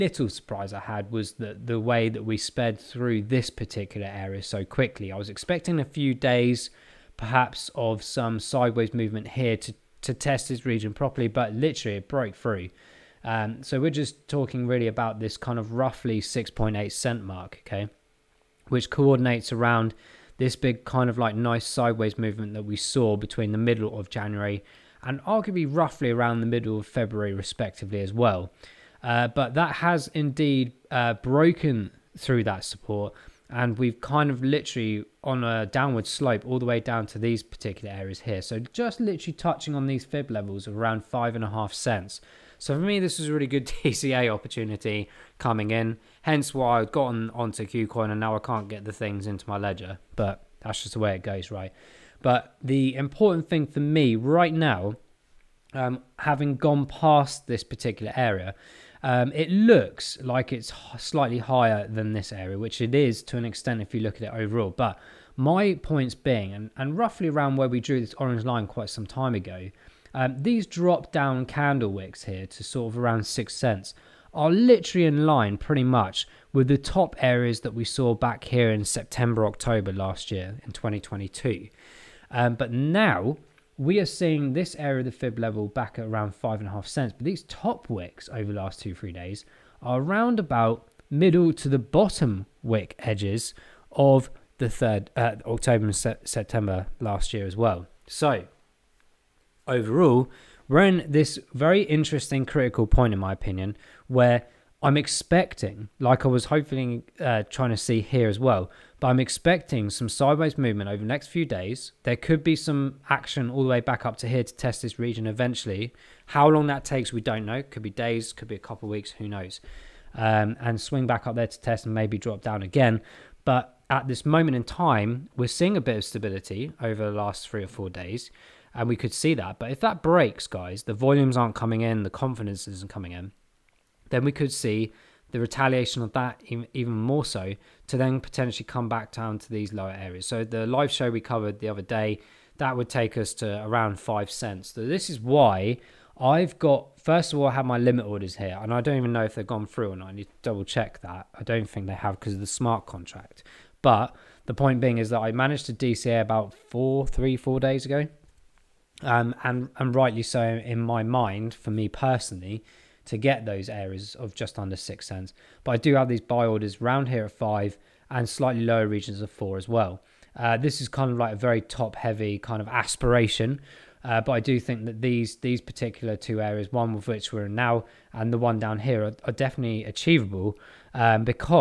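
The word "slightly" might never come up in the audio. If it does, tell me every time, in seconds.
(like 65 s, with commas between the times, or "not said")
60 s, 168 s.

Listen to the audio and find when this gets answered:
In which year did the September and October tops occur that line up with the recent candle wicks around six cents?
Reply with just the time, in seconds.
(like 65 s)
80 s.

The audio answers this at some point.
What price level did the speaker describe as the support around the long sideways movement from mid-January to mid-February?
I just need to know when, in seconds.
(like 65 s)
16 s.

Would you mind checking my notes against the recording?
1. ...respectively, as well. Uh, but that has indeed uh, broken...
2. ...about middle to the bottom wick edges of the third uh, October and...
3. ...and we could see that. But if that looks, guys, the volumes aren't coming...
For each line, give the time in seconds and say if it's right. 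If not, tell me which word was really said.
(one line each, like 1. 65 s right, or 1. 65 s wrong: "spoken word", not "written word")
1. 27 s right
2. 90 s right
3. 128 s wrong: "breaks", not "looks".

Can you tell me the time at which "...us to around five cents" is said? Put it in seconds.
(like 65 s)
143 s.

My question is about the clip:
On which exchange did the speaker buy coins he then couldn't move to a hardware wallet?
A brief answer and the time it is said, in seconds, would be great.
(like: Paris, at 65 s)
KuCoin, at 47 s.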